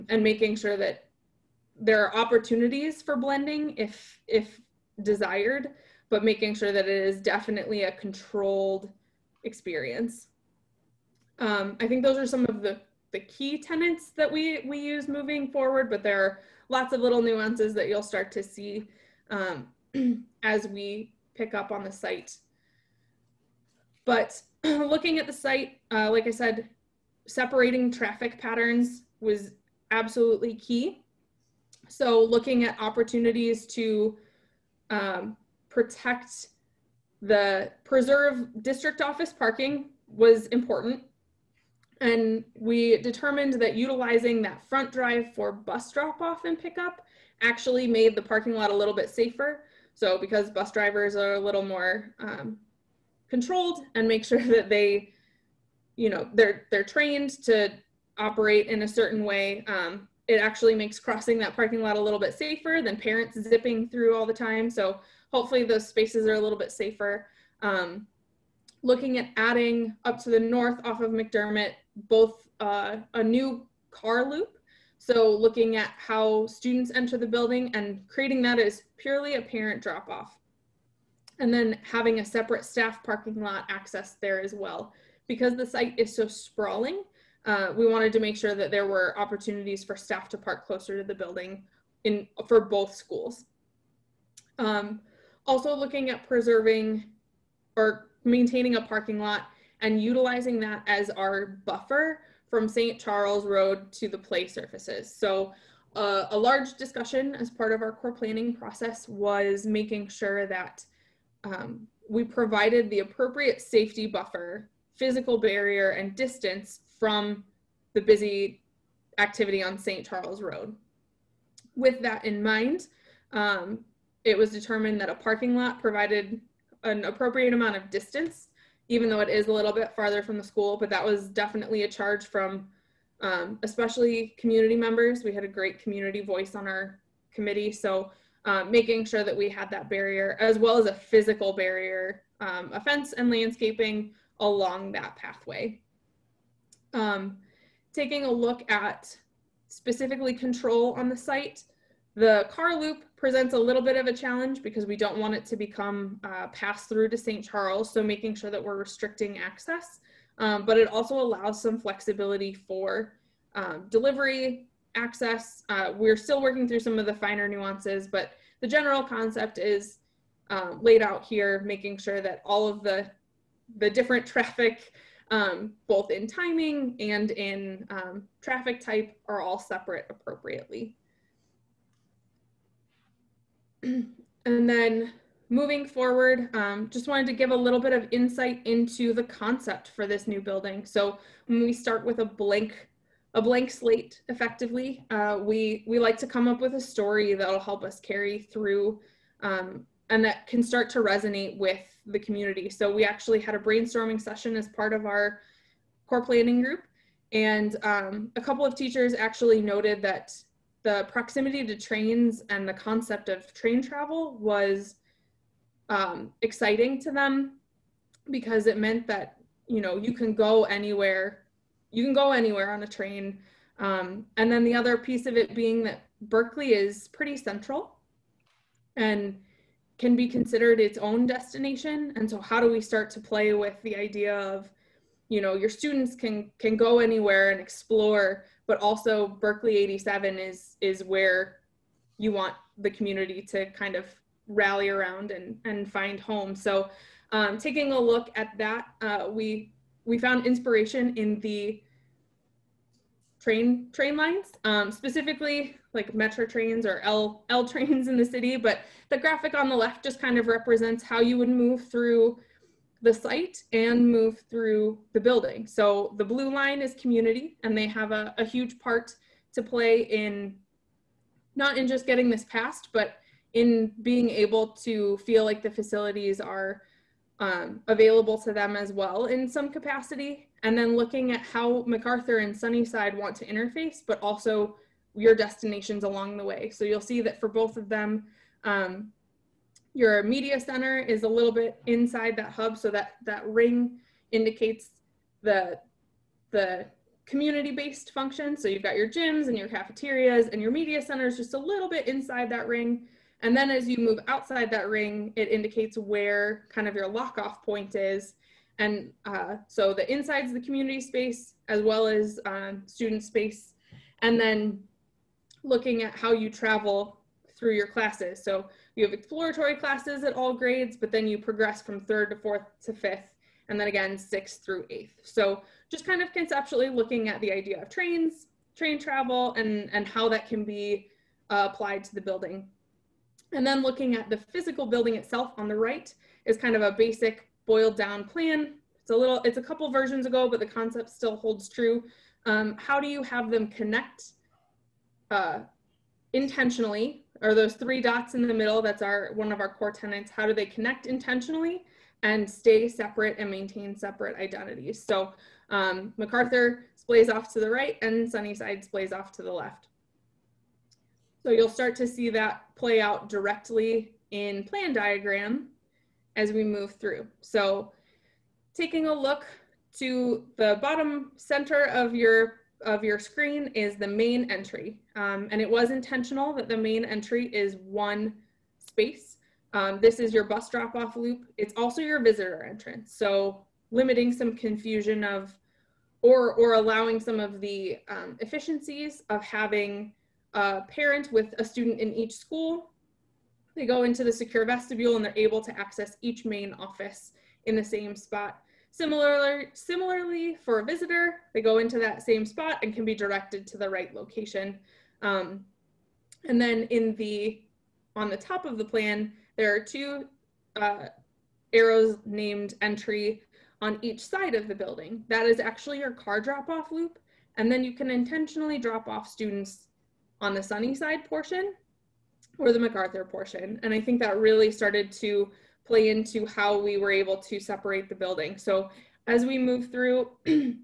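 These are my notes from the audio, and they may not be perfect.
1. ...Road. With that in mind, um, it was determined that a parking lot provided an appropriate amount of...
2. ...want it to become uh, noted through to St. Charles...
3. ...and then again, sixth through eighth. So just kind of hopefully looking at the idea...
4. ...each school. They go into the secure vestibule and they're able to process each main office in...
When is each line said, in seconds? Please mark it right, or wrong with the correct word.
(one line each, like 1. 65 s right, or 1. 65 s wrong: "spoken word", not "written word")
1. 120 s right
2. 155 s wrong: "passed", not "noted"
3. 323 s wrong: "conceptually", not "hopefully"
4. 392 s wrong: "access", not "process".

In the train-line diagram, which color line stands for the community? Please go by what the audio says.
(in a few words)
Blue.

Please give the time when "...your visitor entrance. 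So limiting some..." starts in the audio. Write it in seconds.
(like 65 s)
382 s.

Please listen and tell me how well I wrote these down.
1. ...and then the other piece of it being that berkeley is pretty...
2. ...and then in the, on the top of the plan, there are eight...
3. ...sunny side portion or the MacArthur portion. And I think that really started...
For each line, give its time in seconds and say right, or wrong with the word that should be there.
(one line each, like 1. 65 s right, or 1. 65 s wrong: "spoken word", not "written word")
1. 224 s right
2. 406 s wrong: "two", not "eight"
3. 420 s right.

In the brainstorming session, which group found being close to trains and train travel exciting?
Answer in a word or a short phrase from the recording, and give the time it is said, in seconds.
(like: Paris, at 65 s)
Teachers, at 208 s.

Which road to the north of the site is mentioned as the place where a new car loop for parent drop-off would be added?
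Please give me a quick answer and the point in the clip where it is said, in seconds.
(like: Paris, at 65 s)
McDermott, at 71 s.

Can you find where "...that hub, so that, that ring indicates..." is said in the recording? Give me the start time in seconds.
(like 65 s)
292 s.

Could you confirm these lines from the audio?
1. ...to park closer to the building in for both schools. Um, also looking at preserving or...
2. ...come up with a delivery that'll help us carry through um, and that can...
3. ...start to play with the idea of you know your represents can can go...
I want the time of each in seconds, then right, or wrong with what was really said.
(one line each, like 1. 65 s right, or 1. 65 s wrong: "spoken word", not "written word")
1. 90 s right
2. 196 s wrong: "story", not "delivery"
3. 232 s wrong: "students", not "represents".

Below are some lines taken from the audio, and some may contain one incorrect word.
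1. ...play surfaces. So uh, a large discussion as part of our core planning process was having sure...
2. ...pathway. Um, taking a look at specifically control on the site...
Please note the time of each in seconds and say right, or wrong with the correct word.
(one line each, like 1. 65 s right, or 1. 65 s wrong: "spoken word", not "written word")
1. 104 s wrong: "making", not "having"
2. 145 s right.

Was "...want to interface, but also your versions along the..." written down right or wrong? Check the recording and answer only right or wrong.
wrong.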